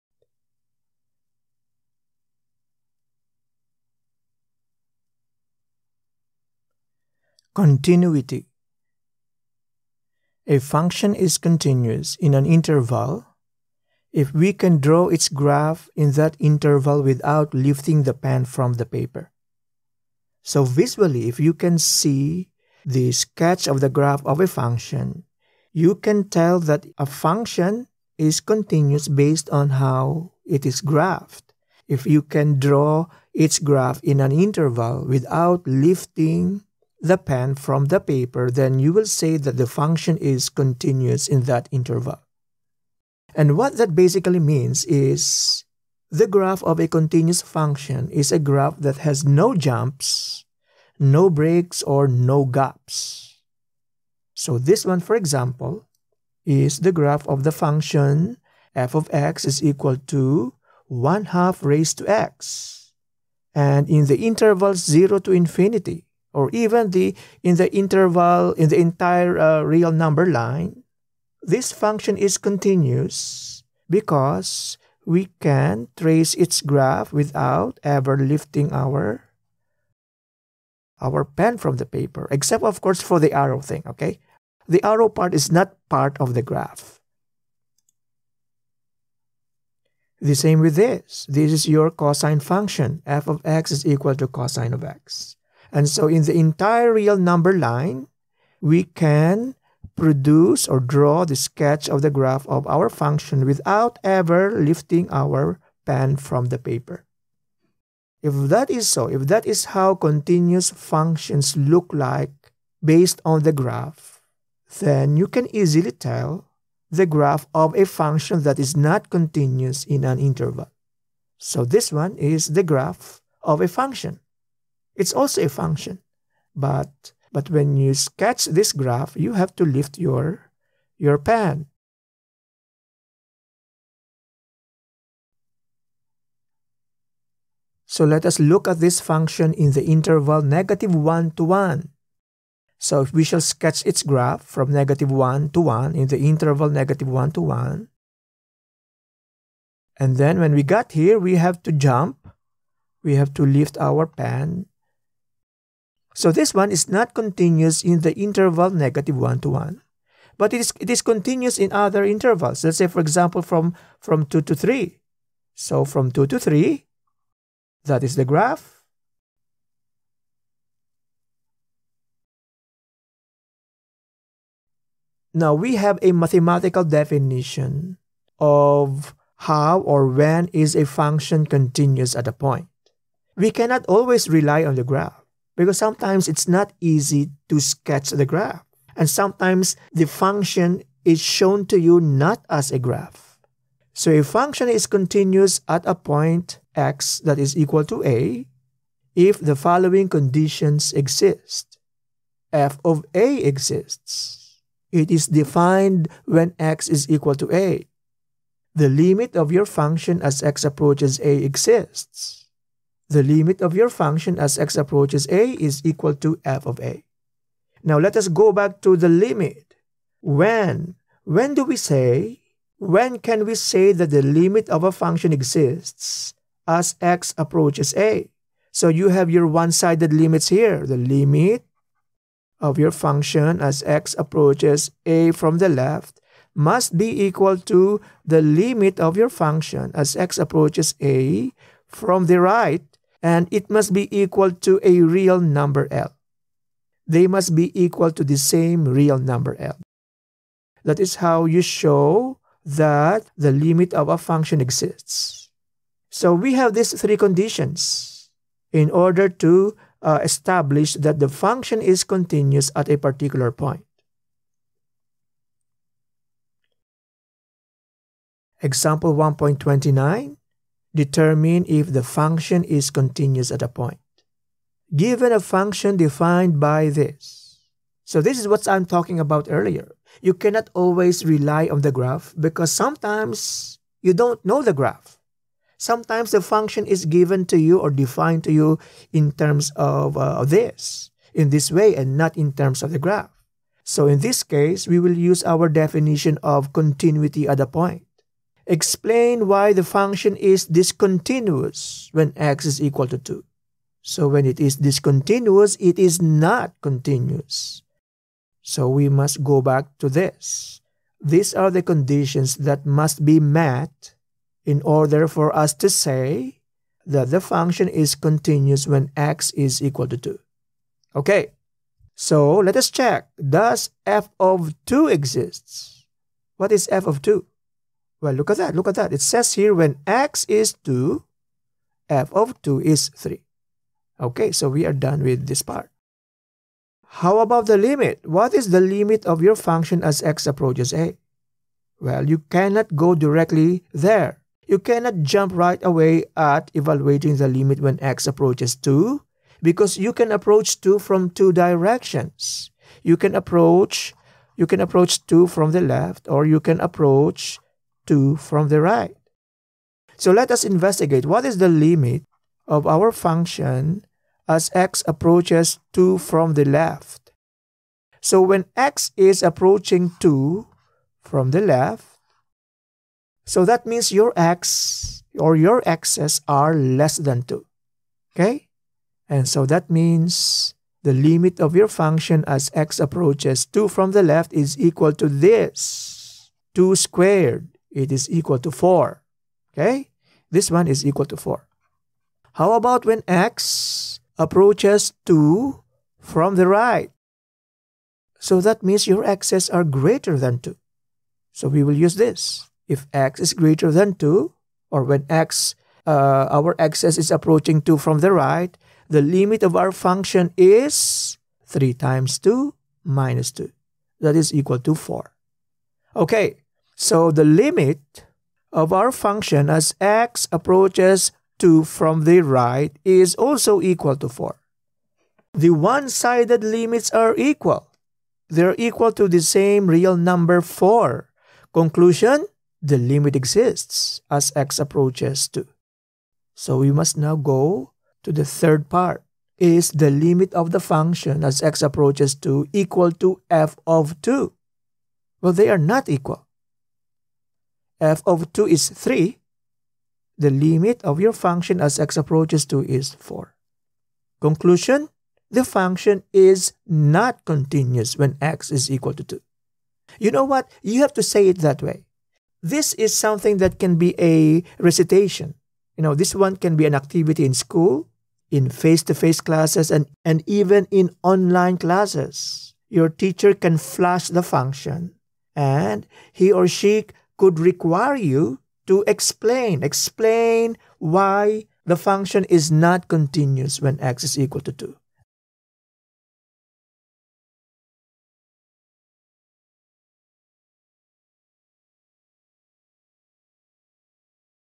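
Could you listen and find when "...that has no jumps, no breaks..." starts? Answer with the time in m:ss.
0:48.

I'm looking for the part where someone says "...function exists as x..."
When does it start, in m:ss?
3:44.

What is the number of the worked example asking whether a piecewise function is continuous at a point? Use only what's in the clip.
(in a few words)
1.29.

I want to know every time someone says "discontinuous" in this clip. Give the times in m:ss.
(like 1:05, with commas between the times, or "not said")
5:00, 5:04.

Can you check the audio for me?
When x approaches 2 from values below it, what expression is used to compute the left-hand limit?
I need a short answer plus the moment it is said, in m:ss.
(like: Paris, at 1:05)
2 squared, at 6:26.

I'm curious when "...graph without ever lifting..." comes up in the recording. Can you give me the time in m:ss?
1:16.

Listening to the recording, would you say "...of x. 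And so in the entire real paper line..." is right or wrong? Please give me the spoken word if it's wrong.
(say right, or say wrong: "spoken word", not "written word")
wrong: "number", not "paper".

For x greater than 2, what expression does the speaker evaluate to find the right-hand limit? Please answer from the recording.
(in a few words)
3 times 2 minus 2.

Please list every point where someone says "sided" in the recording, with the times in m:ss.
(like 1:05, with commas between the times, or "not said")
3:49, 7:05.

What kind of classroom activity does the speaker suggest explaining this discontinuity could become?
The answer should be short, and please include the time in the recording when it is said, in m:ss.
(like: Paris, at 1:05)
recitation, at 7:44.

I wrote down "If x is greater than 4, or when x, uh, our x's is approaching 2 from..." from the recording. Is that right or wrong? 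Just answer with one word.
wrong.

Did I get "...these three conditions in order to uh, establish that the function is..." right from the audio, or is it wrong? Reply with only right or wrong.
right.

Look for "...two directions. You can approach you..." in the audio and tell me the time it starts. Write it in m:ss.
5:51.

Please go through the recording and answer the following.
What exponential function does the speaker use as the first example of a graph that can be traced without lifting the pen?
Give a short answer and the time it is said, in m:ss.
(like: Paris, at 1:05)
1/2 raised to x, at 1:00.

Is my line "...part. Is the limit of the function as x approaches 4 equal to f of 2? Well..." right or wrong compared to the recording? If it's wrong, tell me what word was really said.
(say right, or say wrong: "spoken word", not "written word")
wrong: "2", not "4".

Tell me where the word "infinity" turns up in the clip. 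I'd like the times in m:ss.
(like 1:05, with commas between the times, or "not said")
1:05.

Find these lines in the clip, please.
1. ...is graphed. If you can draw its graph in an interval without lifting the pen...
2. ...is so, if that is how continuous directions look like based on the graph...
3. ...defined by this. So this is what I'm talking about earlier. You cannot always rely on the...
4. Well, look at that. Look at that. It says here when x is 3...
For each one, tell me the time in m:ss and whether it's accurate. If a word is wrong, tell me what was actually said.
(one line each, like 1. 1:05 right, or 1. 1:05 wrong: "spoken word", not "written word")
1. 0:30 right
2. 1:48 wrong: "functions", not "directions"
3. 4:35 right
4. 5:28 wrong: "2", not "3".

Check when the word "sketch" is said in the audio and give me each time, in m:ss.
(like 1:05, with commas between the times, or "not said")
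0:23, 1:41, 2:07, 2:23, 3:07.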